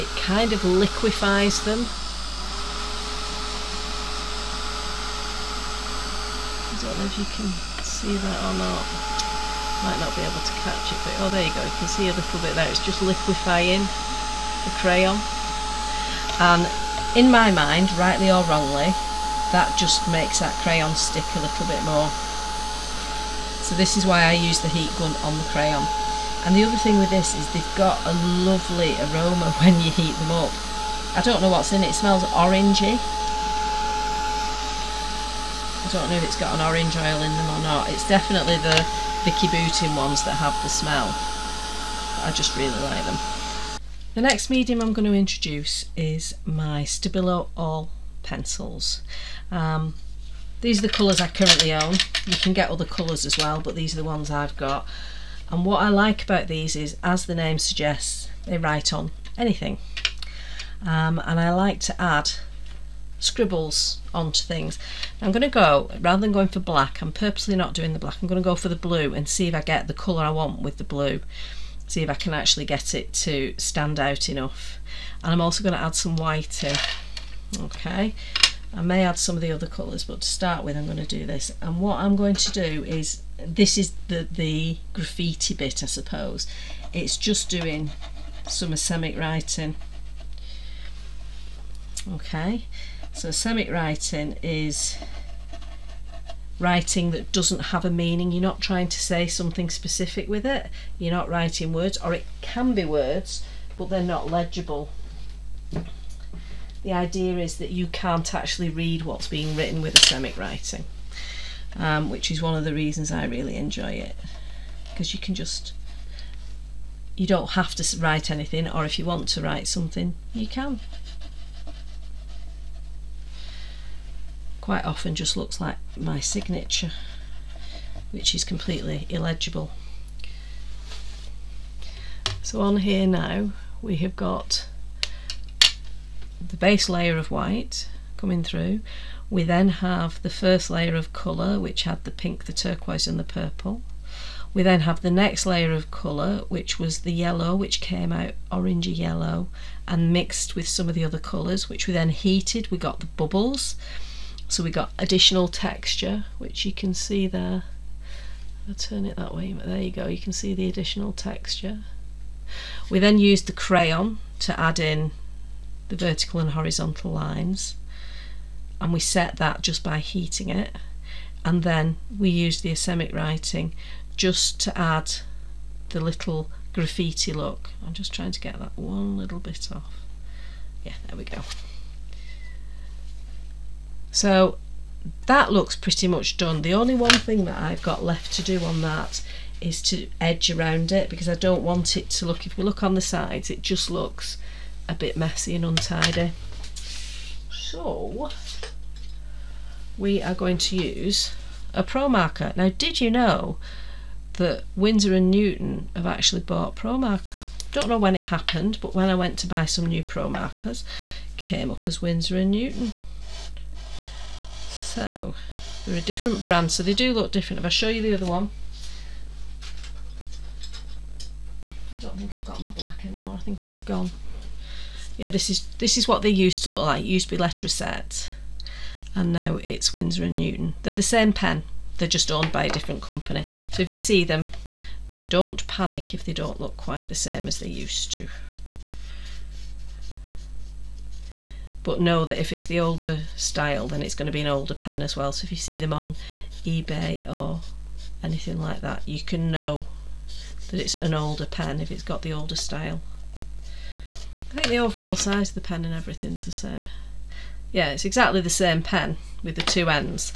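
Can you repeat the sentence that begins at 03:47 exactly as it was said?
It used to be Letraset, and now it's Winsor and Newton.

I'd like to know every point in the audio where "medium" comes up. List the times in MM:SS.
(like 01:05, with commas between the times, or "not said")
00:44.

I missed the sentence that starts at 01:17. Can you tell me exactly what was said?
Okay, I may add some of the other colours, but to start with I'm going to do this.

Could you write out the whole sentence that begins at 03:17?
So we are going to use a Pro Marker.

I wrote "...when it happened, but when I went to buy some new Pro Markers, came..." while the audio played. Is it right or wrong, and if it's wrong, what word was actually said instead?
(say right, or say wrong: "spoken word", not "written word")
right.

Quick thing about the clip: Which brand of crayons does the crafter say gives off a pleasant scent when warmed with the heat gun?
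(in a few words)
Vicki Boutin.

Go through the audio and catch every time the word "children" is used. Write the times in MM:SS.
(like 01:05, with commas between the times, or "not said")
not said.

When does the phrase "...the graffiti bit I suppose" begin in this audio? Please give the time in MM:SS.
01:24.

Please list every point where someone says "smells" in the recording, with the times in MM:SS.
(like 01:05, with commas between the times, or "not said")
00:31, 00:40.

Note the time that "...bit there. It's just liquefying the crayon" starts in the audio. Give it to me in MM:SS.
00:12.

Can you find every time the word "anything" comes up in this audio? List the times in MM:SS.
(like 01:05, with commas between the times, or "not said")
00:59, 01:58, 04:08.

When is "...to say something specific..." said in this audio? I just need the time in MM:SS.
01:38.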